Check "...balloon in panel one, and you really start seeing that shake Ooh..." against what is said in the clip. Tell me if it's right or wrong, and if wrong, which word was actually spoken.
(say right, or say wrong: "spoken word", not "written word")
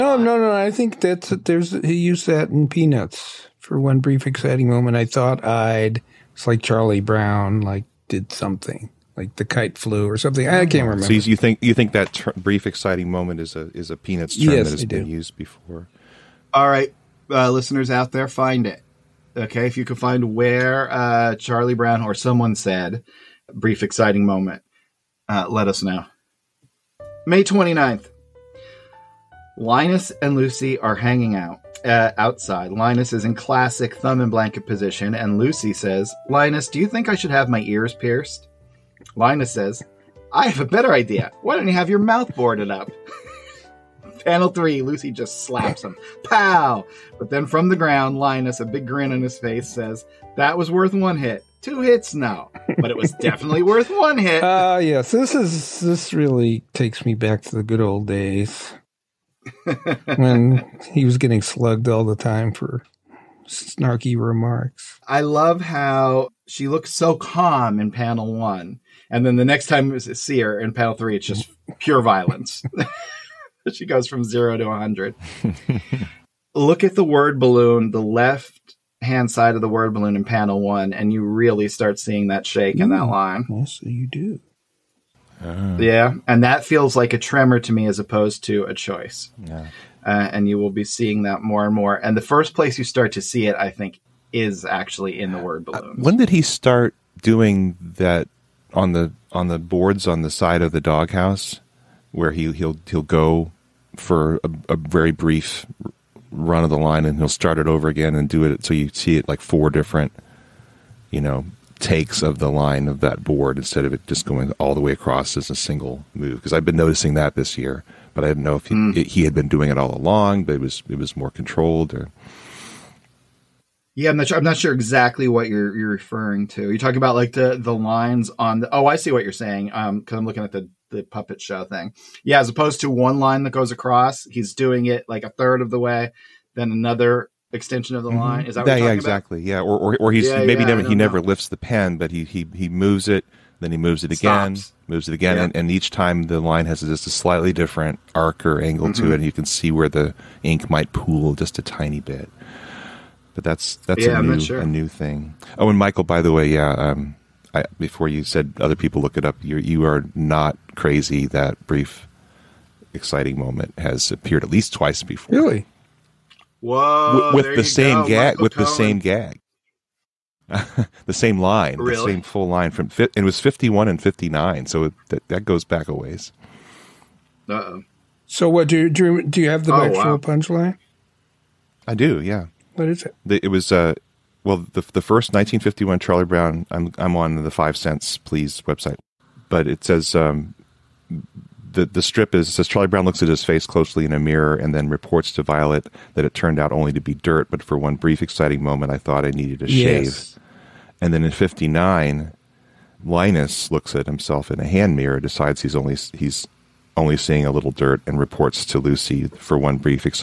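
right.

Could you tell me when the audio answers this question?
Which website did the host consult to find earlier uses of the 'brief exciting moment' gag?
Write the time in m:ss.
3:07.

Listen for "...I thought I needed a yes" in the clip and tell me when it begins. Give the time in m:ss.
3:18.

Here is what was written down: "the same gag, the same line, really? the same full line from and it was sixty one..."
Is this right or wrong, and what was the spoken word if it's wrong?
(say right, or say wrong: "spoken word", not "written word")
wrong: "fifty", not "sixty".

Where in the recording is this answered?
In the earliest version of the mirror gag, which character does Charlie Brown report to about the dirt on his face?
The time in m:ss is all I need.
3:15.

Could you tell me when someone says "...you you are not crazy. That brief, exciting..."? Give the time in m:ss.
2:39.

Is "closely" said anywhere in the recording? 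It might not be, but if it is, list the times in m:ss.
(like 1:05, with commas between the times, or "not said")
3:13.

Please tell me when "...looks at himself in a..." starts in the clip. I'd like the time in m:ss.
3:23.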